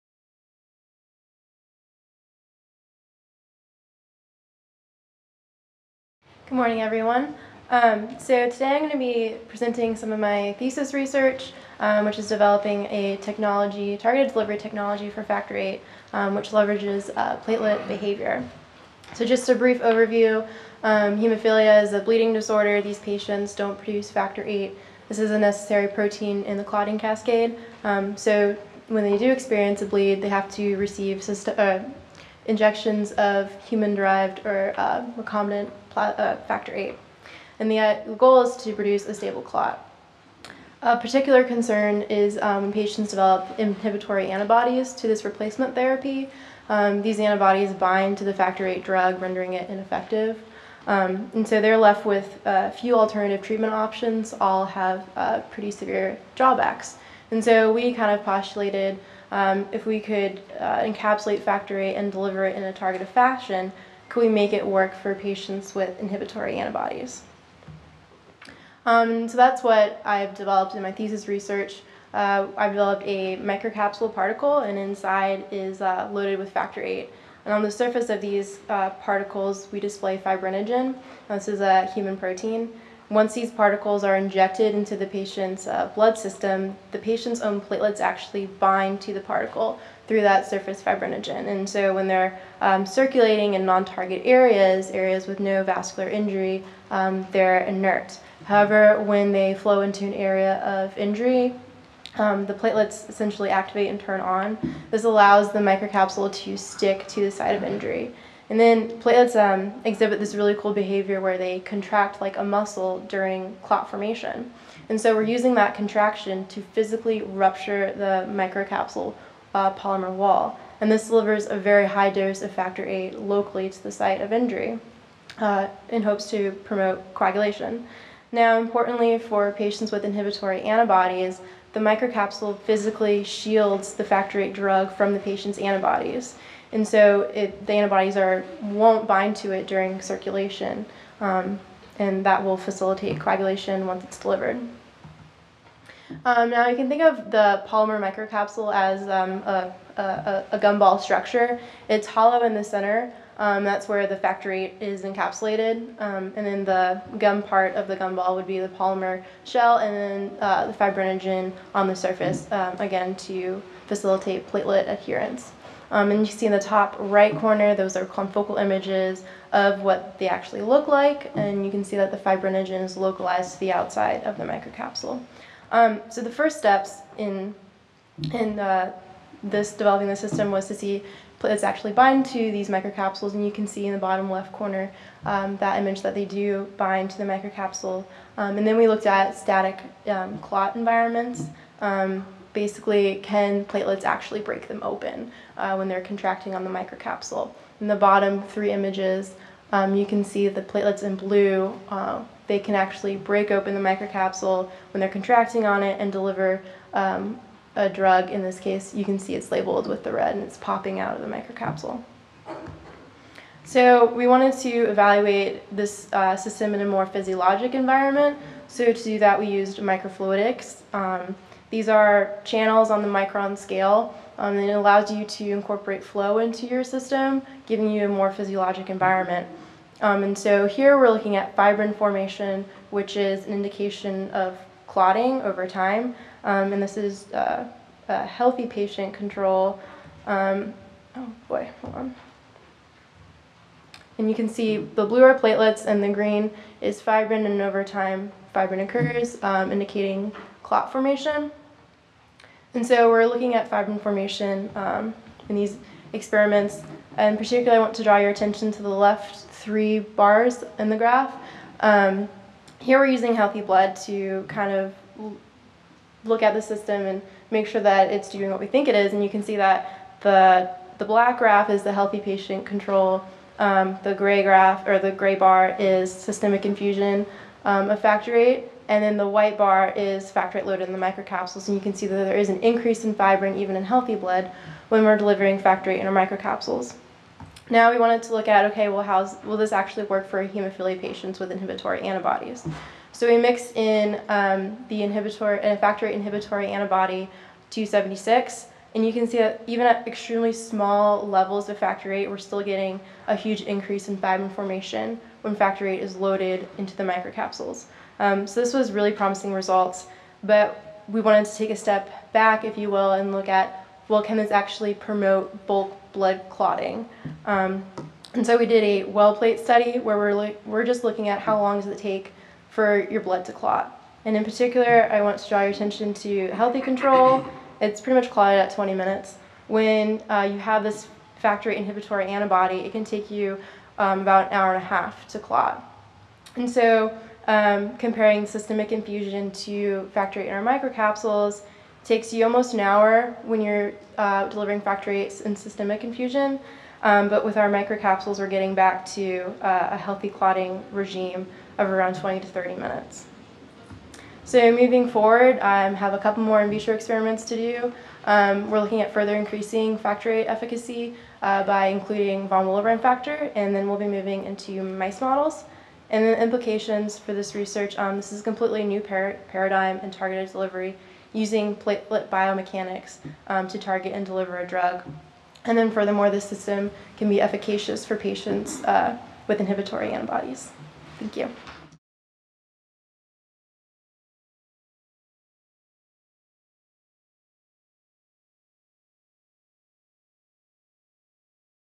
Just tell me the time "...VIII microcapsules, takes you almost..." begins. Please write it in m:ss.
5:40.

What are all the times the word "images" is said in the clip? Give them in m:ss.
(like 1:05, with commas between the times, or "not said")
2:48, 3:05, 3:18.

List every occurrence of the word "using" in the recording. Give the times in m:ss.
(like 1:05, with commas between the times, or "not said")
1:55, 4:23, 6:11.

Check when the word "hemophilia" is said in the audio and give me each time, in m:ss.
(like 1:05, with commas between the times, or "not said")
0:21, 4:50.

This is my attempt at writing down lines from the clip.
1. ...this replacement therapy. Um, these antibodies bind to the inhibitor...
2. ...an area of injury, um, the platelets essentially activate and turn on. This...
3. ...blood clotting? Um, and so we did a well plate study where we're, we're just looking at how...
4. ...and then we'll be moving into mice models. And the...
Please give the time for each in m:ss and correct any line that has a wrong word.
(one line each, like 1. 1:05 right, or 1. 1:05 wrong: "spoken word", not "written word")
1. 0:45 wrong: "factor", not "inhibitor"
2. 1:40 right
3. 5:16 right
4. 6:03 right.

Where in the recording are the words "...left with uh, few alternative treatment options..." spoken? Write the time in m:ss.
0:51.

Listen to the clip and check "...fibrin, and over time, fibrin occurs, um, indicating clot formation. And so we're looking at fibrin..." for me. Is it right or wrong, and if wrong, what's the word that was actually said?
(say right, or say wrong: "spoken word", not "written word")
right.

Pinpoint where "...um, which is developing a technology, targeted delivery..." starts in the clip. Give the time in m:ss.
0:11.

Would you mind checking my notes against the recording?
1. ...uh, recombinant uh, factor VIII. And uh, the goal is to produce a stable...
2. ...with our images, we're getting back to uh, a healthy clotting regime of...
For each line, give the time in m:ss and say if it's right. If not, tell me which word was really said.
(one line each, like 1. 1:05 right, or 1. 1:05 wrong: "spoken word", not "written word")
1. 0:34 right
2. 5:47 wrong: "microcapsules", not "images".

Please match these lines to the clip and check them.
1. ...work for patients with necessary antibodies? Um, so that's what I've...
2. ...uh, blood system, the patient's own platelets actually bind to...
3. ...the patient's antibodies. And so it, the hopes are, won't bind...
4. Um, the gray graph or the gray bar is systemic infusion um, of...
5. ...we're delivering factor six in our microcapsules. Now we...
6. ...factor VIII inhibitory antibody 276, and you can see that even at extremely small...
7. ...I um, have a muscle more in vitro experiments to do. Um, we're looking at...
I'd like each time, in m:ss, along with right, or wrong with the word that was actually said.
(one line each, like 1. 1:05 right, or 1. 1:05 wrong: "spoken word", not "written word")
1. 1:04 wrong: "inhibitory", not "necessary"
2. 1:25 right
3. 2:15 wrong: "antibodies", not "hopes"
4. 4:33 right
5. 4:45 wrong: "eight", not "six"
6. 4:55 right
7. 5:55 wrong: "couple", not "muscle".